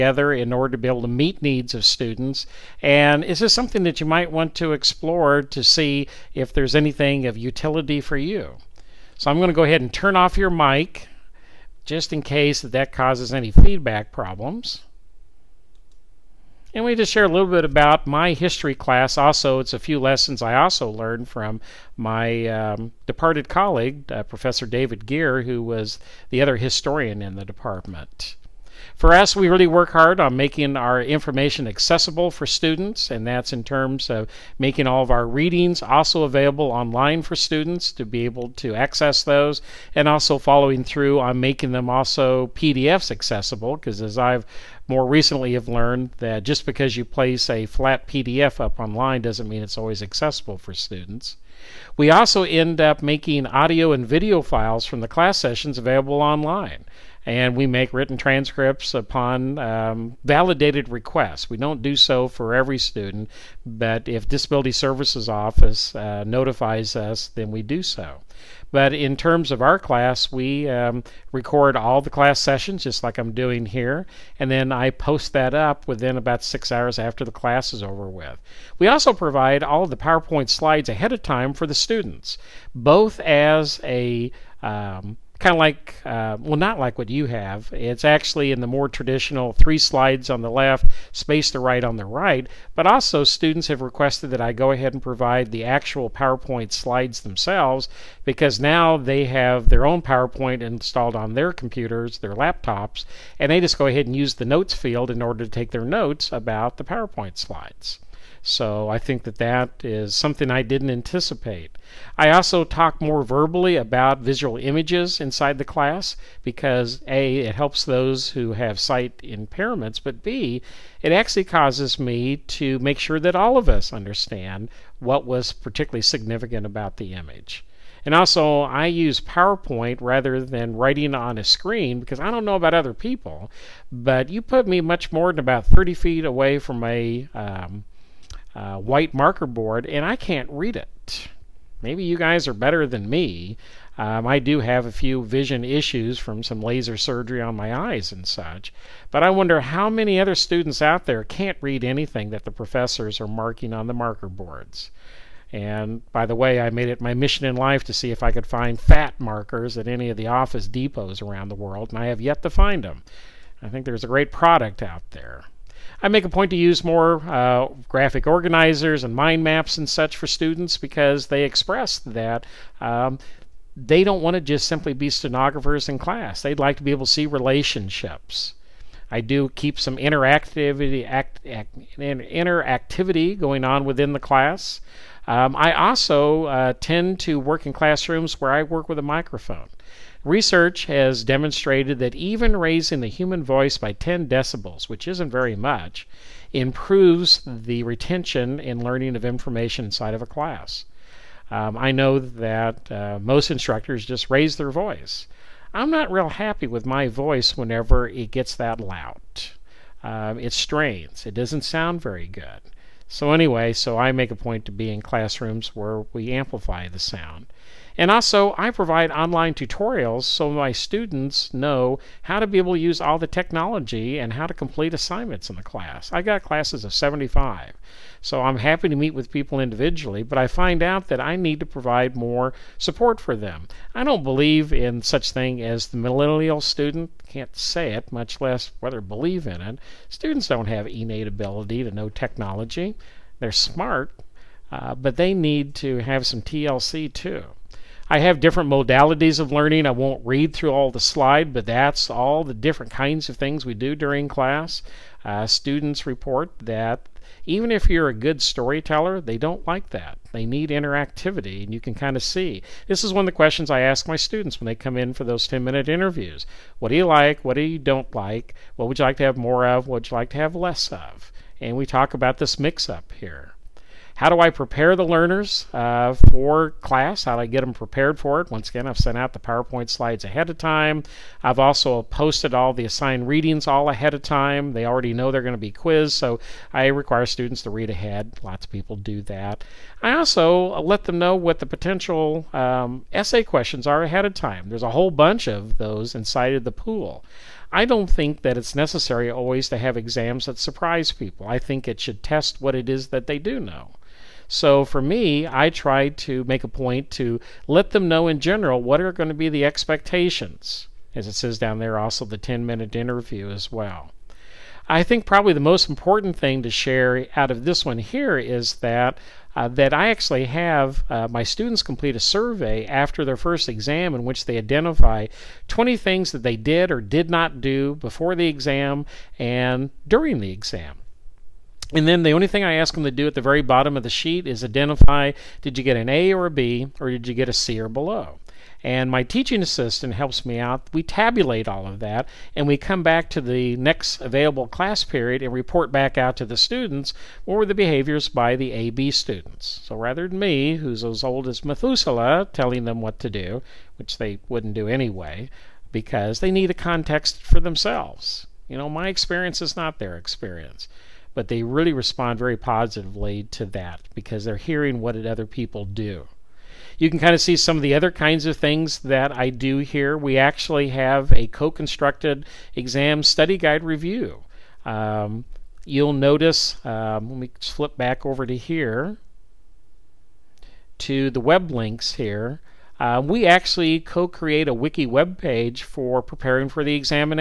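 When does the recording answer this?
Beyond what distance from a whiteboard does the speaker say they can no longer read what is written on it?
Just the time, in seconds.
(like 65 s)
135 s.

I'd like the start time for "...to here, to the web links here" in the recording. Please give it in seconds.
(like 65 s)
378 s.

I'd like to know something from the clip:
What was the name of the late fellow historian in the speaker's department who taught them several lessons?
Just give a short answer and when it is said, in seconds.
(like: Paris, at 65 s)
David Ghere, at 24 s.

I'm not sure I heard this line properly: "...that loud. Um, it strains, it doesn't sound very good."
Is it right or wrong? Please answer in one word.
right.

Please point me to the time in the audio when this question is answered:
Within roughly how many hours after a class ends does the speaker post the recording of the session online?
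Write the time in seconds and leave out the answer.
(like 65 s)
76 s.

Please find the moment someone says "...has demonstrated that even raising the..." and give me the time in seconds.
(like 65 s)
190 s.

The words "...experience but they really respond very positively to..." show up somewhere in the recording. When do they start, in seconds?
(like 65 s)
360 s.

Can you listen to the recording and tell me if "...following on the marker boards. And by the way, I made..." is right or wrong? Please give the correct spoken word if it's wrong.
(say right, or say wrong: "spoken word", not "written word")
wrong: "marking", not "following".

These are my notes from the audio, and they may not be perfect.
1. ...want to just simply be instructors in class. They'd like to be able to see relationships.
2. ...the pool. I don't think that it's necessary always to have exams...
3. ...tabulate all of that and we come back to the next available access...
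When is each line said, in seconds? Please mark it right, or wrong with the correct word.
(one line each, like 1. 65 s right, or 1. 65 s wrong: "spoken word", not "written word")
1. 174 s wrong: "stenographers", not "instructors"
2. 296 s right
3. 341 s wrong: "class", not "access".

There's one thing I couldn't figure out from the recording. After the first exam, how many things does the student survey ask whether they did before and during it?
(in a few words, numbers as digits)
20.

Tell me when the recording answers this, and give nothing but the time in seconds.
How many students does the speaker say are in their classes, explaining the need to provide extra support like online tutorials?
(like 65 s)
226 s.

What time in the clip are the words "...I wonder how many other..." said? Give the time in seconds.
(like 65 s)
149 s.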